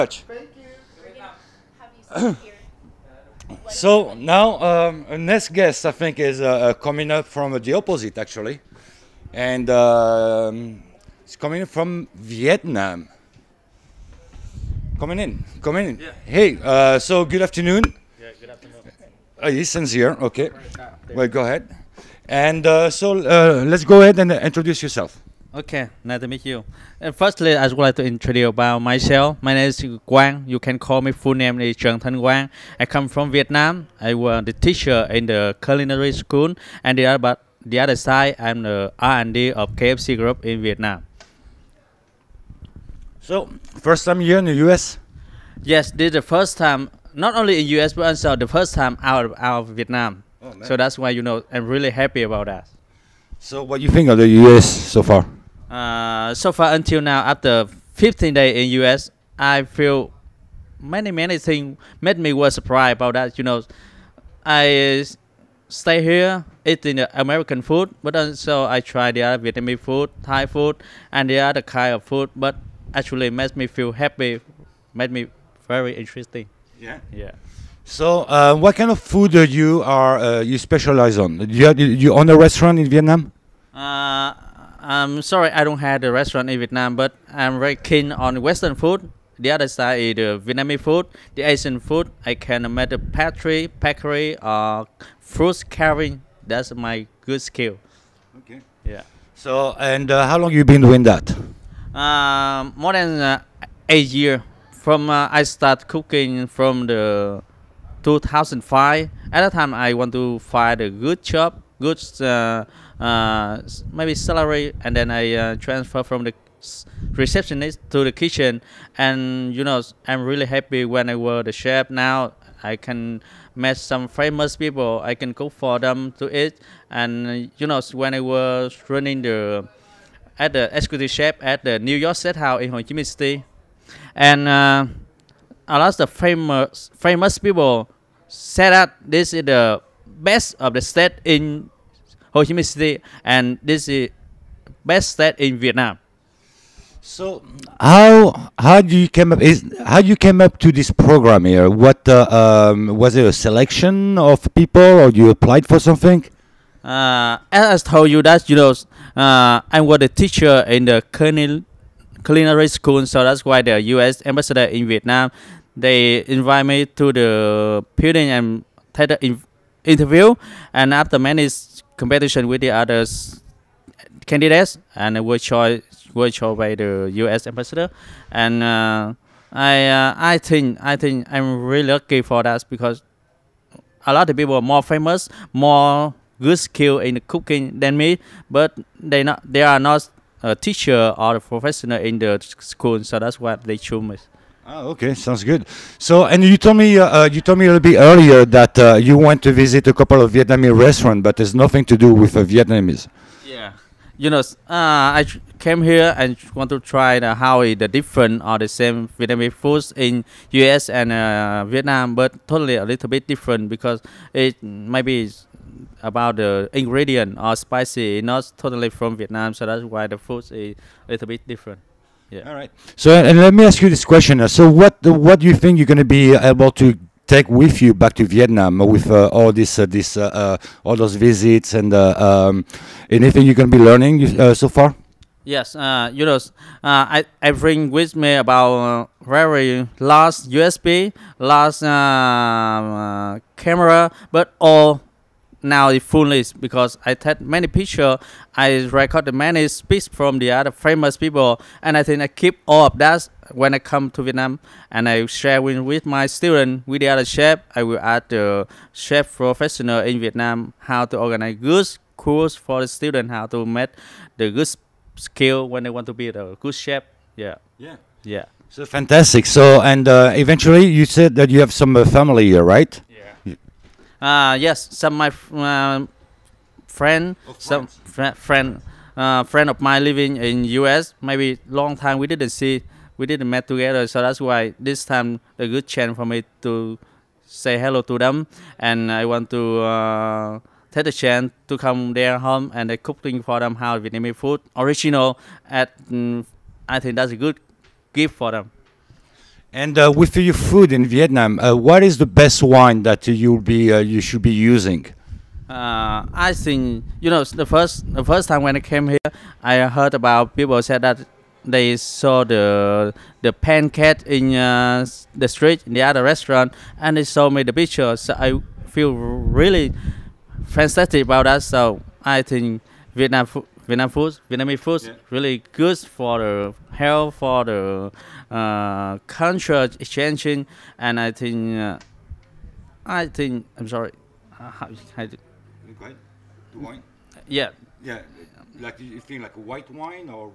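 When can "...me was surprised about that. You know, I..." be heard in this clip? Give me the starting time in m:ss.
1:02.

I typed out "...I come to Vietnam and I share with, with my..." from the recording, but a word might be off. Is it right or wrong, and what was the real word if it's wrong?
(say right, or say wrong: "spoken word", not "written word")
right.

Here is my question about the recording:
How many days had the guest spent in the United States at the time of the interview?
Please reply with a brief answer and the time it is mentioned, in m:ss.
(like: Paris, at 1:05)
15, at 0:57.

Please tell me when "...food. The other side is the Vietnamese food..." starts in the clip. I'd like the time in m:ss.
1:28.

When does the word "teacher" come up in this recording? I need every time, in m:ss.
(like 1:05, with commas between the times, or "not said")
0:34, 2:40, 3:10.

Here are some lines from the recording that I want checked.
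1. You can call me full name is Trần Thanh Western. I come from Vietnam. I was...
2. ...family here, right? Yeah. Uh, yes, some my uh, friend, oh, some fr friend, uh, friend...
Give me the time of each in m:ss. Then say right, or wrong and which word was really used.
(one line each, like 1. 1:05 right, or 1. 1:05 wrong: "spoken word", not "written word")
1. 0:30 wrong: "Quang", not "Western"
2. 4:32 right.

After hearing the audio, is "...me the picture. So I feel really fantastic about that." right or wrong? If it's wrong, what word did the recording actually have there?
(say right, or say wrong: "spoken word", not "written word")
right.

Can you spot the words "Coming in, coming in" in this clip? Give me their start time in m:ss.
0:14.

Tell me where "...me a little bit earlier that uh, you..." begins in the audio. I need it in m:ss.
3:17.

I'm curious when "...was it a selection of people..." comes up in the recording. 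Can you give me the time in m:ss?
2:32.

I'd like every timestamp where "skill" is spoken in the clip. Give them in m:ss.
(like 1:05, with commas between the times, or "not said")
1:37, 3:06, 4:25.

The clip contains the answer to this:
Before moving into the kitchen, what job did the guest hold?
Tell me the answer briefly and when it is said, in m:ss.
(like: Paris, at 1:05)
Receptionist, at 1:57.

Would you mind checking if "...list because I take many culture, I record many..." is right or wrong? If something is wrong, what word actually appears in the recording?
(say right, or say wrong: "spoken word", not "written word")
wrong: "picture", not "culture".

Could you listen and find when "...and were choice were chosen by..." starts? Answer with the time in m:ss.
2:54.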